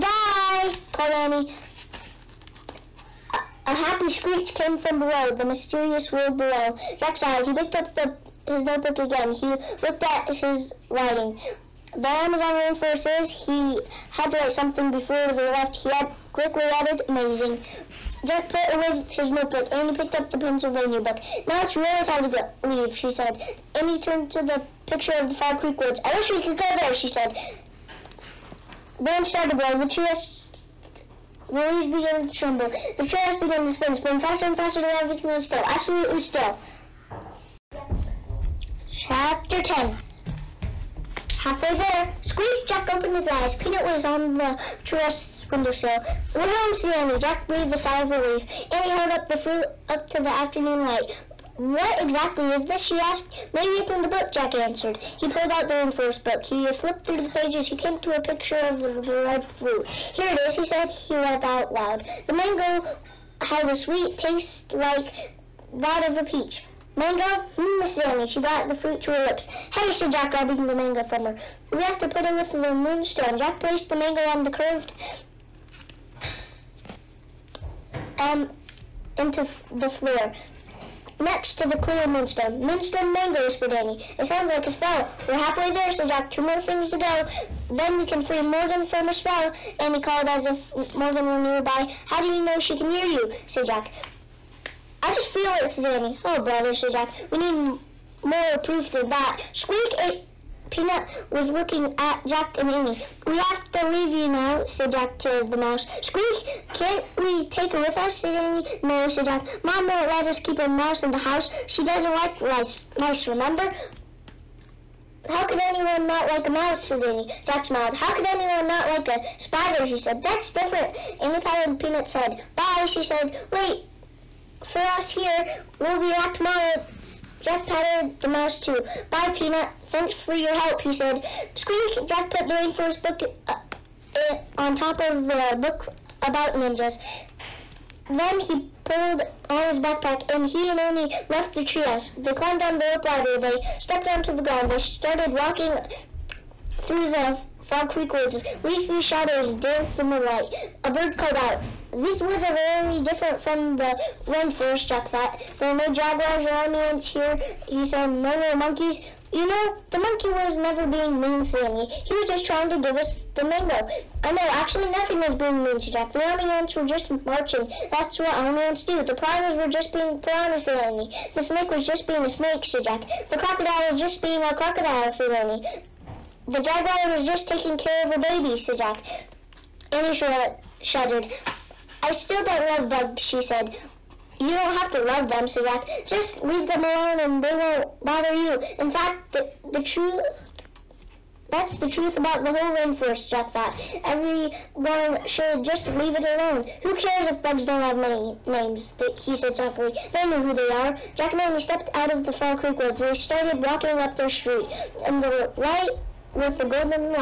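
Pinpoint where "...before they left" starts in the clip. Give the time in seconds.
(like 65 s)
14 s.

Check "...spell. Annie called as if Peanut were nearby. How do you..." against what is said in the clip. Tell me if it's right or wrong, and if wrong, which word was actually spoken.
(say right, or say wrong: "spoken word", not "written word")
wrong: "Morgan", not "Peanut".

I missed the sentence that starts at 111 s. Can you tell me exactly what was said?
She doesn't like rice, mice, remember?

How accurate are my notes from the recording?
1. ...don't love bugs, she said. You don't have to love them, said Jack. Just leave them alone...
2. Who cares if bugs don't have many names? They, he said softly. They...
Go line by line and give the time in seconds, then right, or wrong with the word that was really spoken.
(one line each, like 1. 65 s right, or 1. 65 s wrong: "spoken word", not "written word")
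1. 182 s right
2. 196 s right.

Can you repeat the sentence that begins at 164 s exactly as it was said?
I know, actually, nothing was being mean to Jack.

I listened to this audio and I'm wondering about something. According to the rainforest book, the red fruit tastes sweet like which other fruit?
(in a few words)
Peach.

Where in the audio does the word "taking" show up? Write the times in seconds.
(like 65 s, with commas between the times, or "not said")
177 s.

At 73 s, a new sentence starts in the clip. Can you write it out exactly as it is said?
Jack placed the mango on the curved um, into the floor next to the clear moonstone.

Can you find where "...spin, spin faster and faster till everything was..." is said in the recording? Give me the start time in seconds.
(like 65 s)
33 s.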